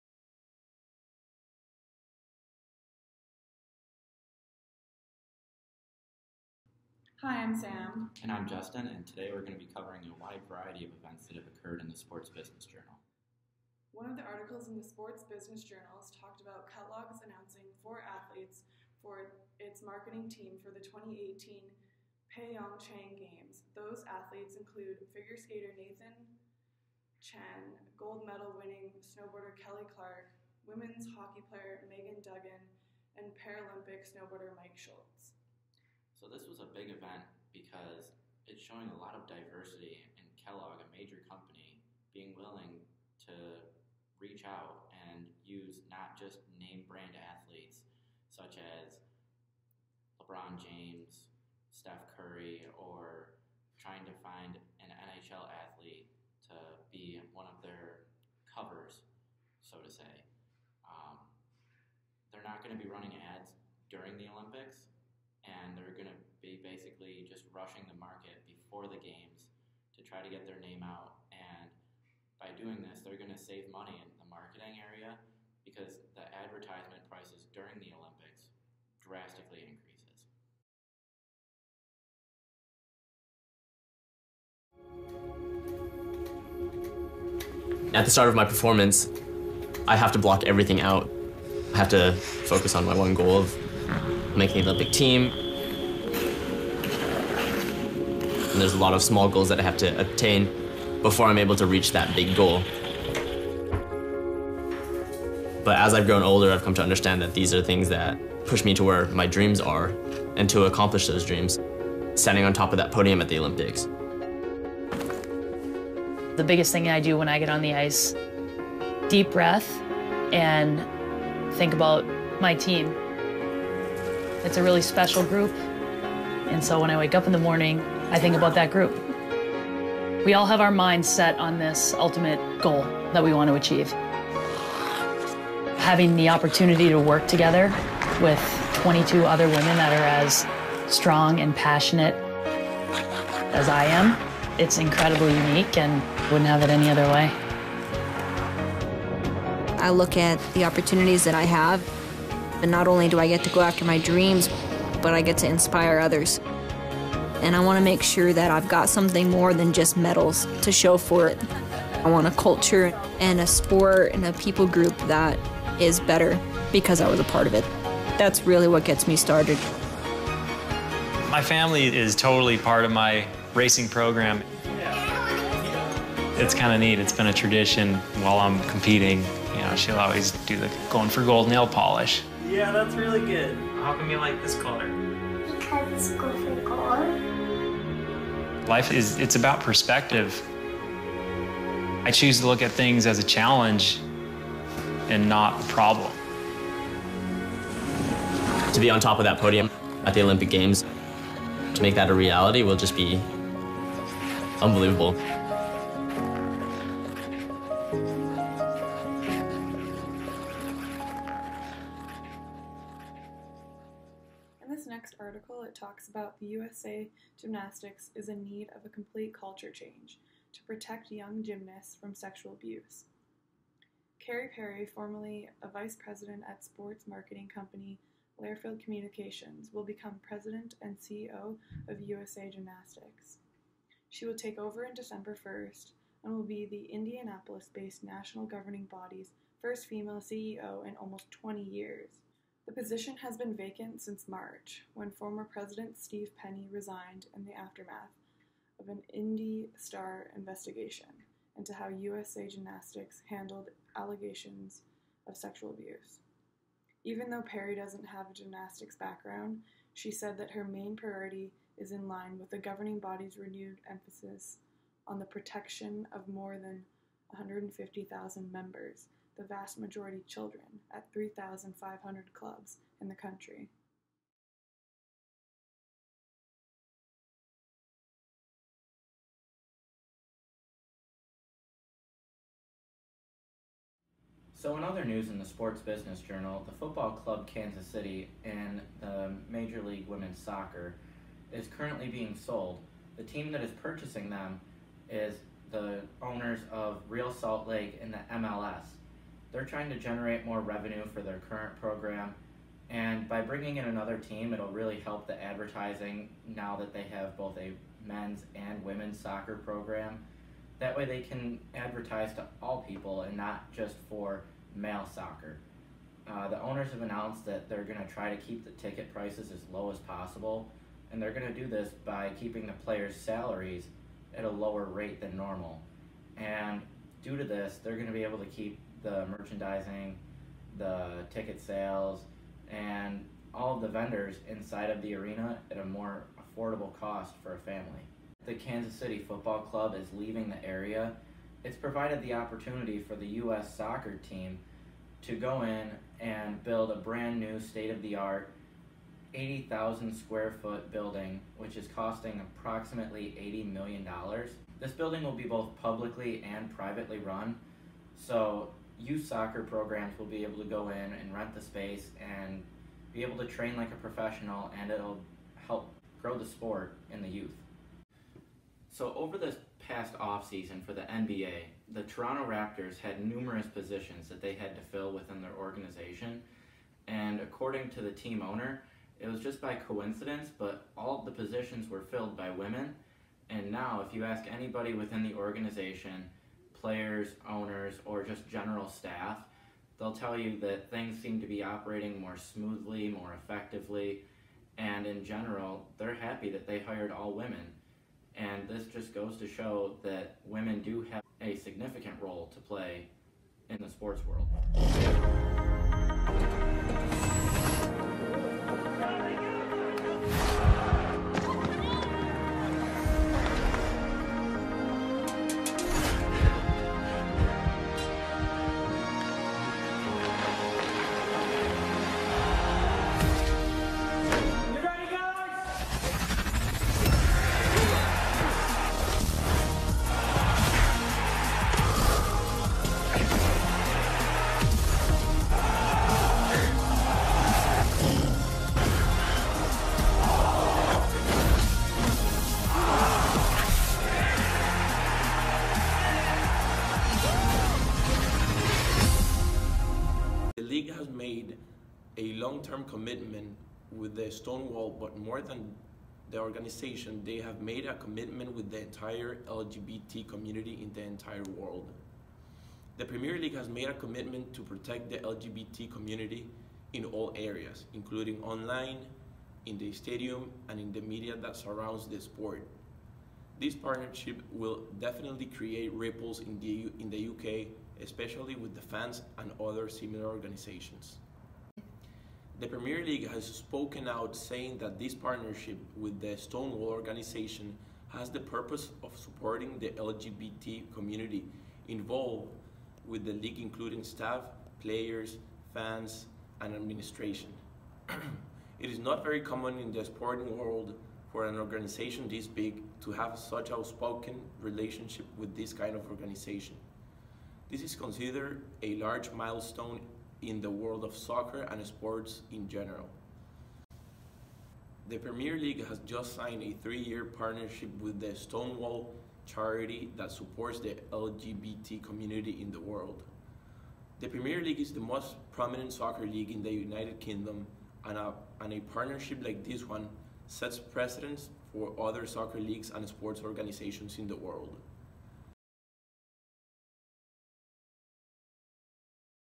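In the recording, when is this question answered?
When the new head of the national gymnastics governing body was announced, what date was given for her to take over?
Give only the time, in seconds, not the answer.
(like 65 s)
234 s.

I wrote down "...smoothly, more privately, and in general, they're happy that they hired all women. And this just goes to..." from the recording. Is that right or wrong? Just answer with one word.
wrong.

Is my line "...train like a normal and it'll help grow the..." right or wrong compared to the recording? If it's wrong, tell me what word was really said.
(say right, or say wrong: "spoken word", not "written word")
wrong: "professional", not "normal".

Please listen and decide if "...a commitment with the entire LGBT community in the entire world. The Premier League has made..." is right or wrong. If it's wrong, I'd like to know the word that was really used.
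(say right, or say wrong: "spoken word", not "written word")
right.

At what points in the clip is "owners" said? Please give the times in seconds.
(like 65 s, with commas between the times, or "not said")
296 s, 316 s, 378 s, 387 s.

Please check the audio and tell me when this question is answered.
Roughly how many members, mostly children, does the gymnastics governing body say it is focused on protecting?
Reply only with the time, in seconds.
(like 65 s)
267 s.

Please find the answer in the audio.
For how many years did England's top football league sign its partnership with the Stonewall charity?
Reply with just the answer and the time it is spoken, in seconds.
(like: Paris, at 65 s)
3, at 516 s.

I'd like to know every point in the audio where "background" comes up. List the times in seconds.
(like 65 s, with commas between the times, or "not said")
258 s.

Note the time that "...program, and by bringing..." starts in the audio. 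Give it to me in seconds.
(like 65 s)
301 s.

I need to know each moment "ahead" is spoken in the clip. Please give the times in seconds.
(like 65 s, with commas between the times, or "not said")
not said.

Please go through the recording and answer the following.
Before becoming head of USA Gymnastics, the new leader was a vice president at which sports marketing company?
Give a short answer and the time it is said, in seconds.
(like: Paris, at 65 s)
Learfield Communications, at 228 s.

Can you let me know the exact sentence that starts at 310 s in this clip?
That way they can advertise to all people and not just for male soccer.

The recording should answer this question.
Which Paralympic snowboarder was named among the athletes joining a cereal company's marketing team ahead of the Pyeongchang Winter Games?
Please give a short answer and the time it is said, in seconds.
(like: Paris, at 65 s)
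Mike Schultz, at 34 s.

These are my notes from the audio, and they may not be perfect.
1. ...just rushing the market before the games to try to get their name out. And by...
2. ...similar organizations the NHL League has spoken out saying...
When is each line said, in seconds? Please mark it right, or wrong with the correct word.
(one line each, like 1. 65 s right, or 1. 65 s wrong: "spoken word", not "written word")
1. 67 s right
2. 479 s wrong: "Premier", not "NHL".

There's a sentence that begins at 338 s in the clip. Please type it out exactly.
The Kansas City Football Club is leaving the area.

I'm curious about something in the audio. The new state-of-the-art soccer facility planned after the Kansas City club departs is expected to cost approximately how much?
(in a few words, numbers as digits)
$80 million.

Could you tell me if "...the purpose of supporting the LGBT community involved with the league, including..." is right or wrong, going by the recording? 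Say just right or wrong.
right.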